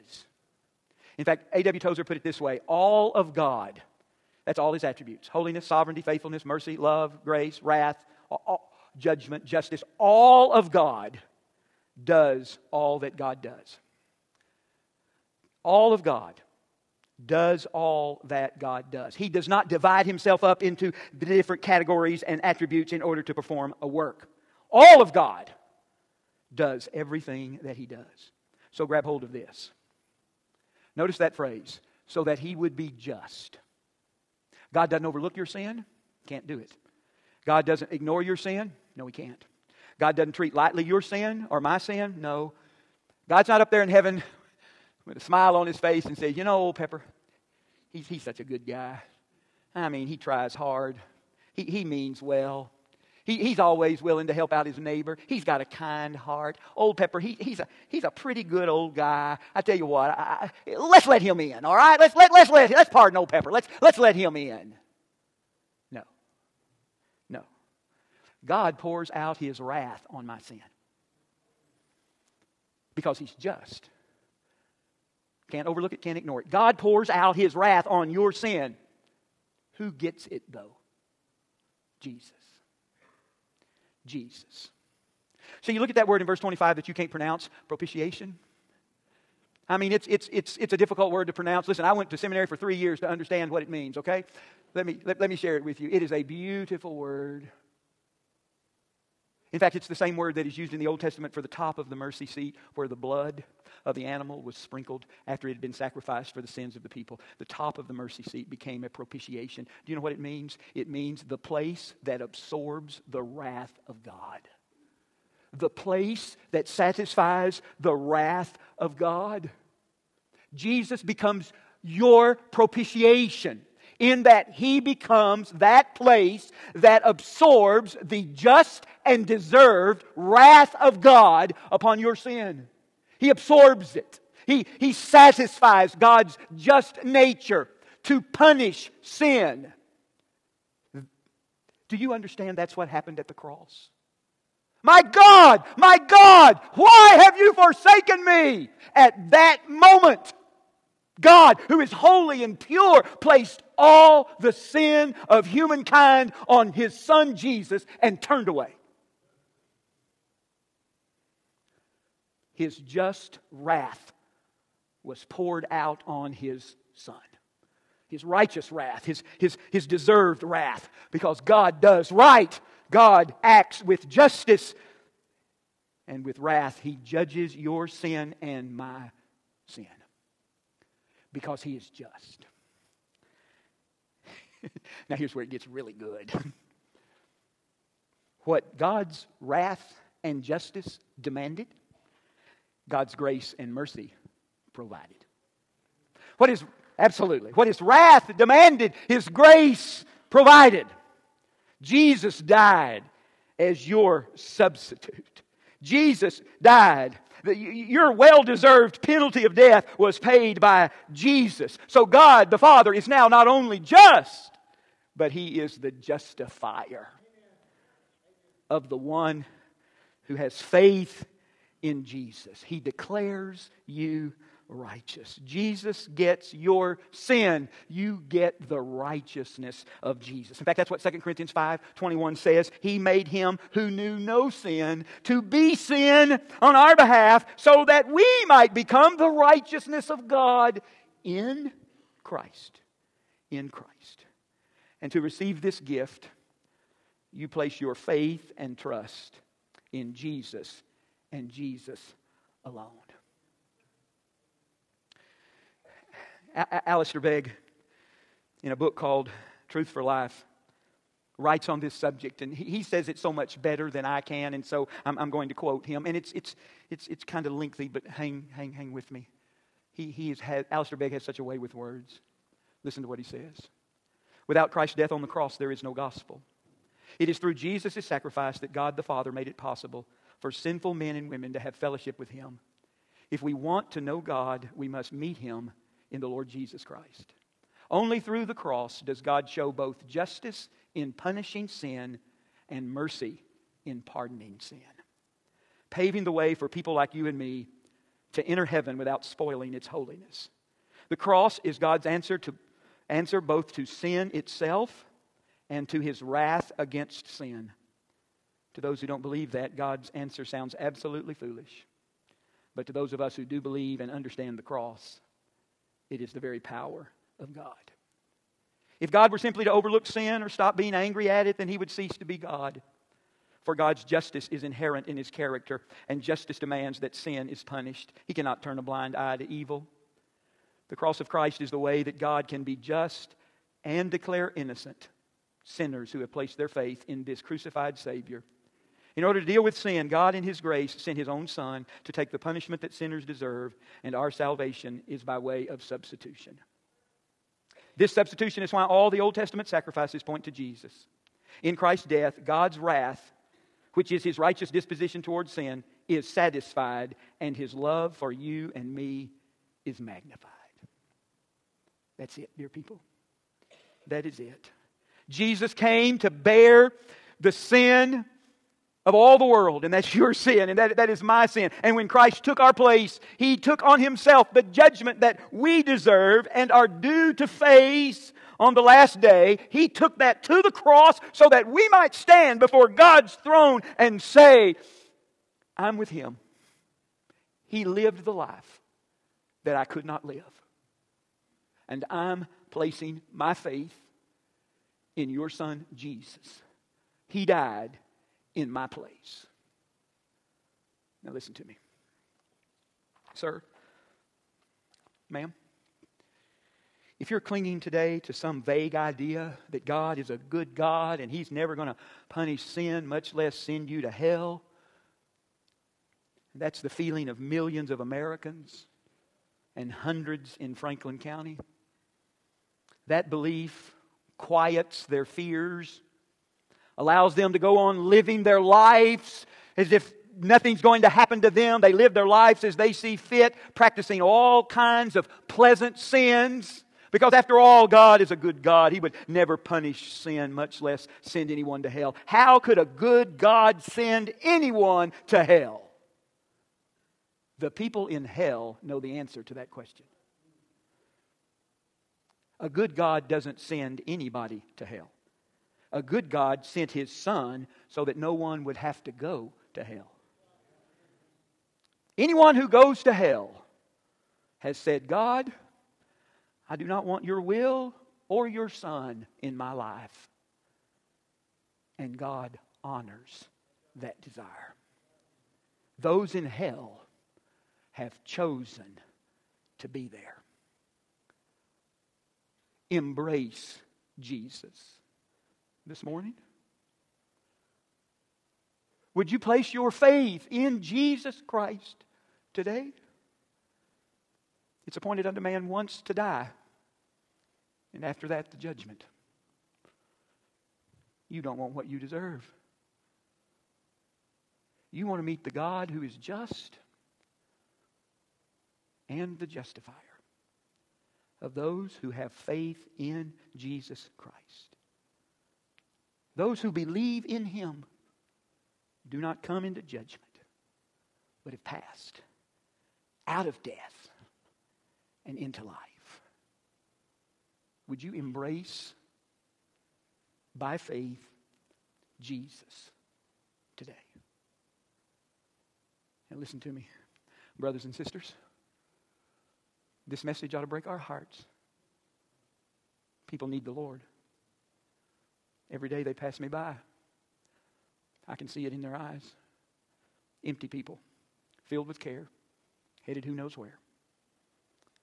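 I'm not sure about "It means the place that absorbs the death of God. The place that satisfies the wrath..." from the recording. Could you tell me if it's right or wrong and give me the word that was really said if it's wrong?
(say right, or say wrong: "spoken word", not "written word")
wrong: "wrath", not "death".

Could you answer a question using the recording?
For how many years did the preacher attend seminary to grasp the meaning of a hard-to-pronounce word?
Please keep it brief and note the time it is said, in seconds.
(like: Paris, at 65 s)
3, at 92 s.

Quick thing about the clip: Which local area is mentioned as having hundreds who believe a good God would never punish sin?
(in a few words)
Franklin County.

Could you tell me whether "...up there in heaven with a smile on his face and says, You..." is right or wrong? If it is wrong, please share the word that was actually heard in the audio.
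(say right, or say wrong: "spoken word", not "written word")
right.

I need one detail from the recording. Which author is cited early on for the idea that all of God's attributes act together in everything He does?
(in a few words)
A.W. Tozer.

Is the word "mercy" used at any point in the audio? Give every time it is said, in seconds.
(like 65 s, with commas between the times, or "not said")
6 s, 101 s, 107 s, 193 s, 292 s.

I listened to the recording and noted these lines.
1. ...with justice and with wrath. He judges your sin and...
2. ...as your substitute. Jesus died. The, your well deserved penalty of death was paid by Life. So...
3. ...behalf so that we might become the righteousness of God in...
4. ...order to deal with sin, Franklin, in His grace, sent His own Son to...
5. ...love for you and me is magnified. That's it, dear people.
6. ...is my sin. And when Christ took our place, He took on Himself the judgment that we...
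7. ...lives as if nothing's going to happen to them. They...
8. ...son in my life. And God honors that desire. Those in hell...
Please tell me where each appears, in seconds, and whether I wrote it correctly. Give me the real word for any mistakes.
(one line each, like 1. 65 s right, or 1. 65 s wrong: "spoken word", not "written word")
1. 173 s right
2. 203 s wrong: "Jesus", not "Life"
3. 236 s right
4. 339 s wrong: "God", not "Franklin"
5. 357 s right
6. 371 s right
7. 428 s right
8. 468 s right.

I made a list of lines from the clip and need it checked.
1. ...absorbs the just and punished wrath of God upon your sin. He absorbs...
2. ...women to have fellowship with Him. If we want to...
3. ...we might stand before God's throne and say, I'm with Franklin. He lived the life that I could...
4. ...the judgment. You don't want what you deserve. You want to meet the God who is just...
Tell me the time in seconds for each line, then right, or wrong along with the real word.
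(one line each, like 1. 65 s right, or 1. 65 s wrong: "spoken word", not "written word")
1. 127 s wrong: "deserved", not "punished"
2. 281 s right
3. 381 s wrong: "Him", not "Franklin"
4. 498 s right.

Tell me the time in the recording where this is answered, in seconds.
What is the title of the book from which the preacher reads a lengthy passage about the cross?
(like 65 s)
259 s.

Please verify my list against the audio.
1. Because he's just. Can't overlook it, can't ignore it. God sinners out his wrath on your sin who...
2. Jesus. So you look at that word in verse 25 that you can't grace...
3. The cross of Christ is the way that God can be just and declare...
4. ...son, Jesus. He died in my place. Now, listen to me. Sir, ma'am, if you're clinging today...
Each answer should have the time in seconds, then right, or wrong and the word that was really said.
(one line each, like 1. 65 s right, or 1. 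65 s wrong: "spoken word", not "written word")
1. 72 s wrong: "pours", not "sinners"
2. 84 s wrong: "pronounce", not "grace"
3. 330 s right
4. 395 s right.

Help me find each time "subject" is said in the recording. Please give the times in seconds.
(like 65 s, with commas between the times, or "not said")
261 s.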